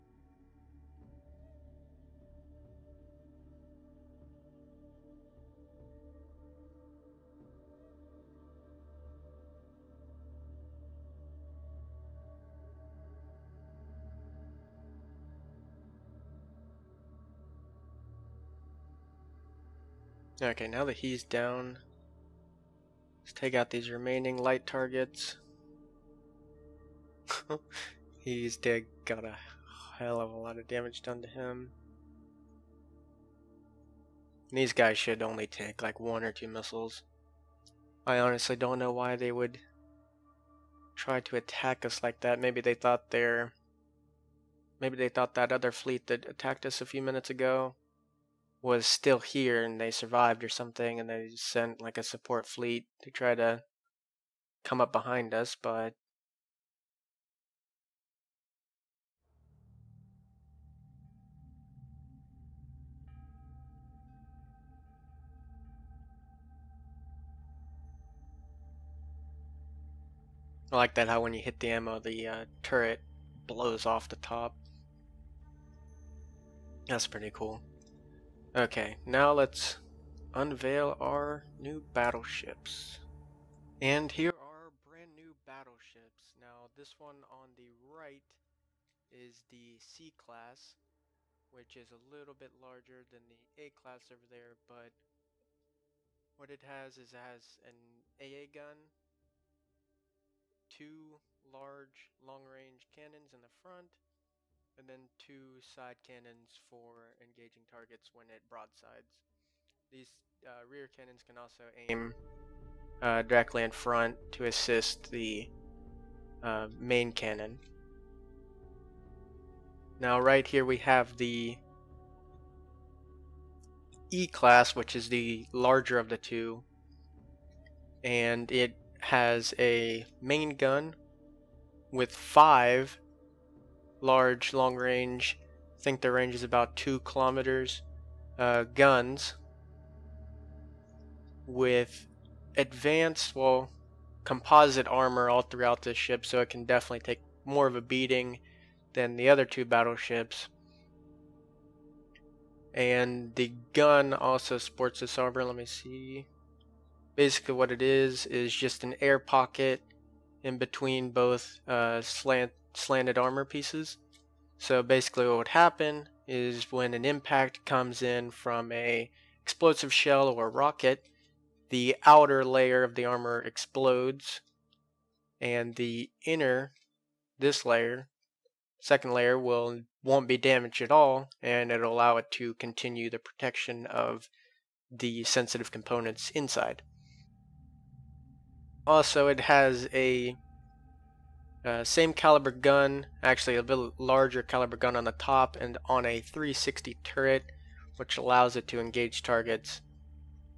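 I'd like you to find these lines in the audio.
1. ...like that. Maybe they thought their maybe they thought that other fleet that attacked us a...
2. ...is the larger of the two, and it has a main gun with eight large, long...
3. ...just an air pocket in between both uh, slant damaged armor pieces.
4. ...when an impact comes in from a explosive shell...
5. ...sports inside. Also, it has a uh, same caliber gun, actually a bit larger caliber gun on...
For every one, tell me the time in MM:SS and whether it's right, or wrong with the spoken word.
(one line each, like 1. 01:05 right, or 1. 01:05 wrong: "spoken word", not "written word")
1. 00:42 right
2. 02:04 wrong: "five", not "eight"
3. 02:38 wrong: "slanted", not "damaged"
4. 02:46 right
5. 03:05 wrong: "components", not "sports".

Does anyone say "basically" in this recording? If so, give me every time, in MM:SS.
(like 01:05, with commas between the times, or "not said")
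02:37, 02:44.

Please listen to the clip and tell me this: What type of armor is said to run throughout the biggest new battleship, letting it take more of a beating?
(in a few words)
Composite armor.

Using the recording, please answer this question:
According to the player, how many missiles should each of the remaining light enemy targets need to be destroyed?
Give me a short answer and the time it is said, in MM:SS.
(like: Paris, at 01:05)
1 or 2, at 00:35.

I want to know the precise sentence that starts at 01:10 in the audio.
I like that how when you hit the ammo, the uh, turret blows off the top.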